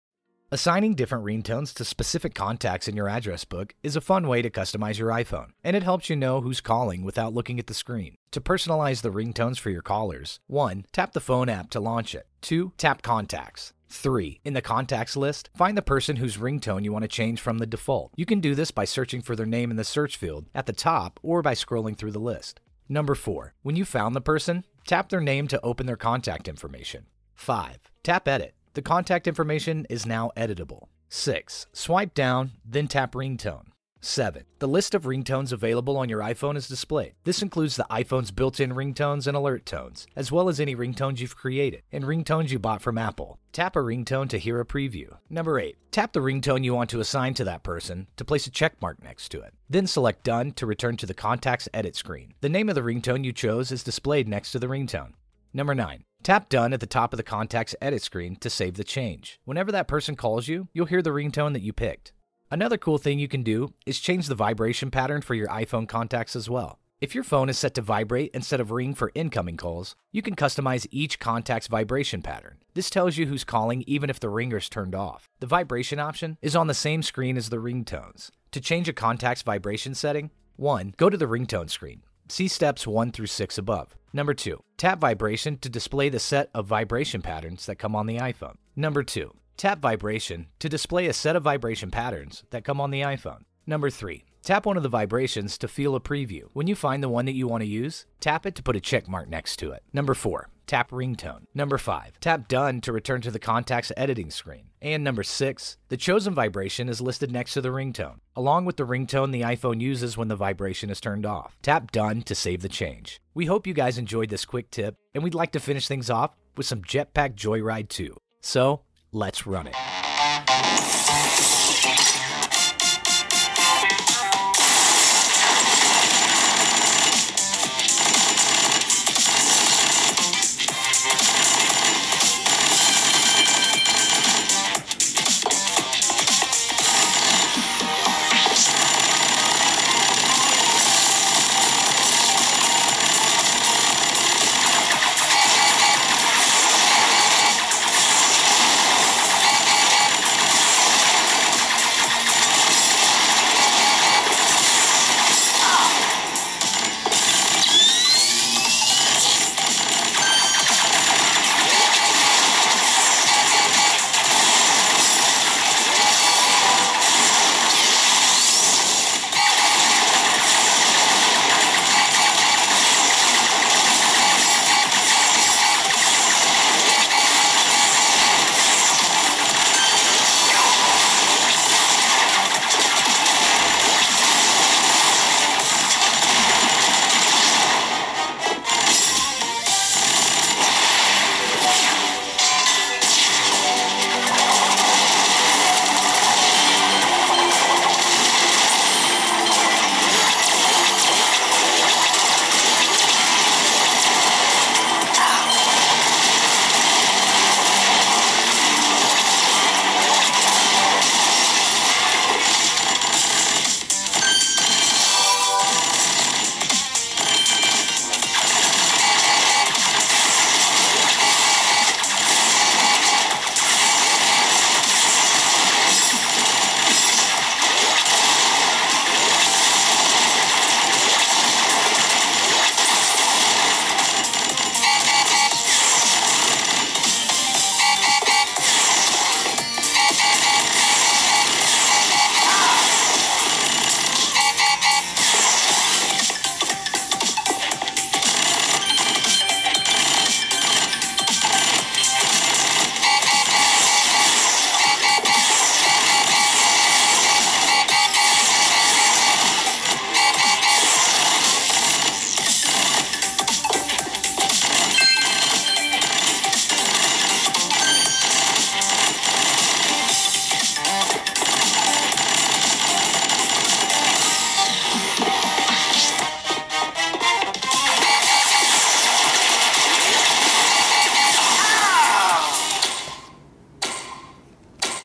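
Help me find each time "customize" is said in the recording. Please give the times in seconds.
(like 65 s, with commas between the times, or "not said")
4 s, 70 s.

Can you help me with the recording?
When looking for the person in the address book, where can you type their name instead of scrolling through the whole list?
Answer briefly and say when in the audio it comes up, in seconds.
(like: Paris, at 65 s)
search field, at 19 s.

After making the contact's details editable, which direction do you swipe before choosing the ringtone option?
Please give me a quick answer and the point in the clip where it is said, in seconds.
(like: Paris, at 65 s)
down, at 32 s.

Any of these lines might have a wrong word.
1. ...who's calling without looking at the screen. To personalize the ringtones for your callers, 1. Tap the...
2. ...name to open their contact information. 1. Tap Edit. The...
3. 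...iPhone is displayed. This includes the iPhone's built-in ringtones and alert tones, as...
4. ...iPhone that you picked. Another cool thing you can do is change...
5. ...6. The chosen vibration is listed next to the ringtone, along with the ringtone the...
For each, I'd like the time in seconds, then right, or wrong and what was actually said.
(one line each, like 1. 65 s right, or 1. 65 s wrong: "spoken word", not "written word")
1. 6 s right
2. 25 s wrong: "5", not "1"
3. 36 s right
4. 61 s wrong: "ringtone", not "iPhone"
5. 105 s right.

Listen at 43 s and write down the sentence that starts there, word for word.
Tap a ringtone to hear a preview.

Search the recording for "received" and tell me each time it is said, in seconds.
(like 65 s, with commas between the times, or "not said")
not said.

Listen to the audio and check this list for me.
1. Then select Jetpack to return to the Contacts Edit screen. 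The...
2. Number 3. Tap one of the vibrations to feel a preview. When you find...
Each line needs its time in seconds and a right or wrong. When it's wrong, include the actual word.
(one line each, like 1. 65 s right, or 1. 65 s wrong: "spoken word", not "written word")
1. 49 s wrong: "Done", not "Jetpack"
2. 93 s right.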